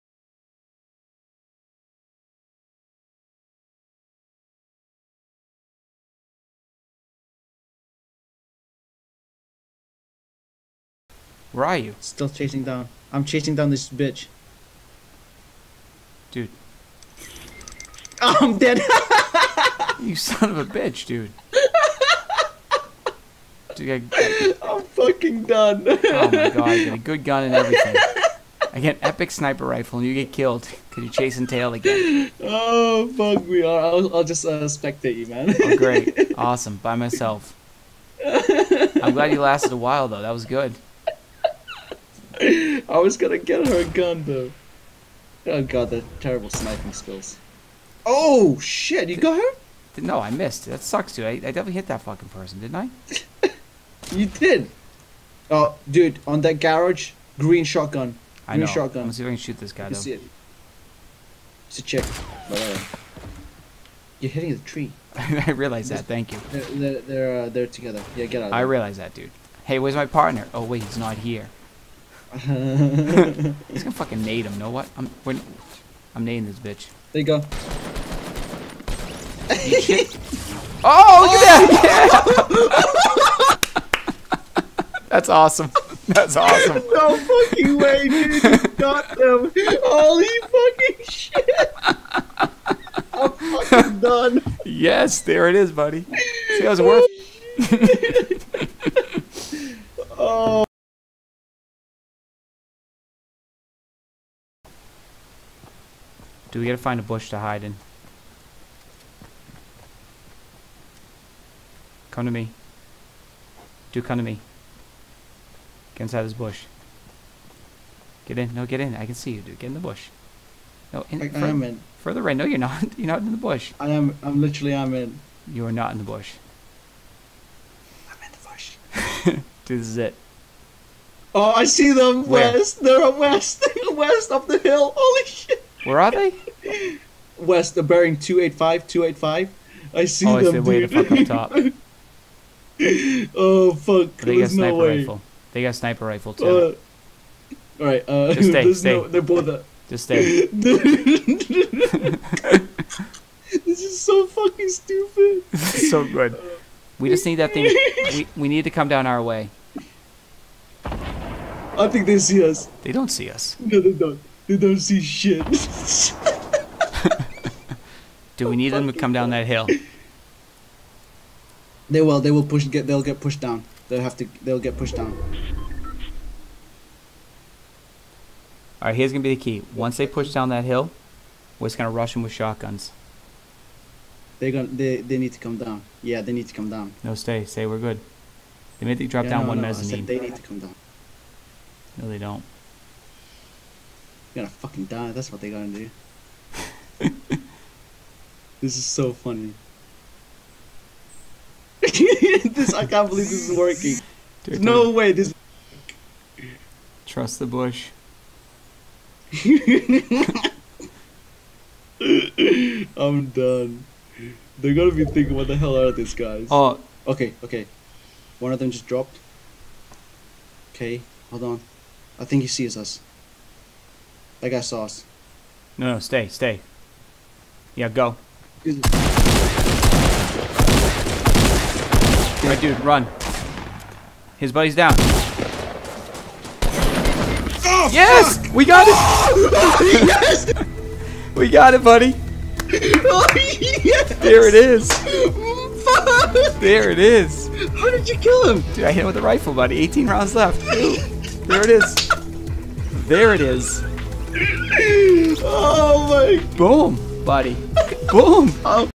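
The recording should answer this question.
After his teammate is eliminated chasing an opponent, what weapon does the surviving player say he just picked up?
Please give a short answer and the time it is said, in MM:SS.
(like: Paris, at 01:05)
epic sniper rifle, at 00:29.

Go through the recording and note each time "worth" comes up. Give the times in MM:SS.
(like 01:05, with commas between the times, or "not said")
01:36.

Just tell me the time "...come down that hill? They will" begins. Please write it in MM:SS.
02:48.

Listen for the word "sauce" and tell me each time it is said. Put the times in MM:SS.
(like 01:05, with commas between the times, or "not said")
03:44.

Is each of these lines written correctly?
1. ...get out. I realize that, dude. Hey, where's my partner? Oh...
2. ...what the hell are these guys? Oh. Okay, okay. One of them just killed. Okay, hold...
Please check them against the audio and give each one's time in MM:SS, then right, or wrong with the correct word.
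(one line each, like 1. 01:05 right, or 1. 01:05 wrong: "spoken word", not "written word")
1. 01:08 right
2. 03:35 wrong: "dropped", not "killed".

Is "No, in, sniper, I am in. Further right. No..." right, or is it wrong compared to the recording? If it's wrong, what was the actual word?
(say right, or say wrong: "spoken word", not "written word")
wrong: "further", not "sniper".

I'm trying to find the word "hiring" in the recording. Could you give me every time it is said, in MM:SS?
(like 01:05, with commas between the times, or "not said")
not said.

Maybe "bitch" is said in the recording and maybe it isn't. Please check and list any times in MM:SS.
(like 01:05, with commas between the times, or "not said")
00:13, 00:20, 01:16.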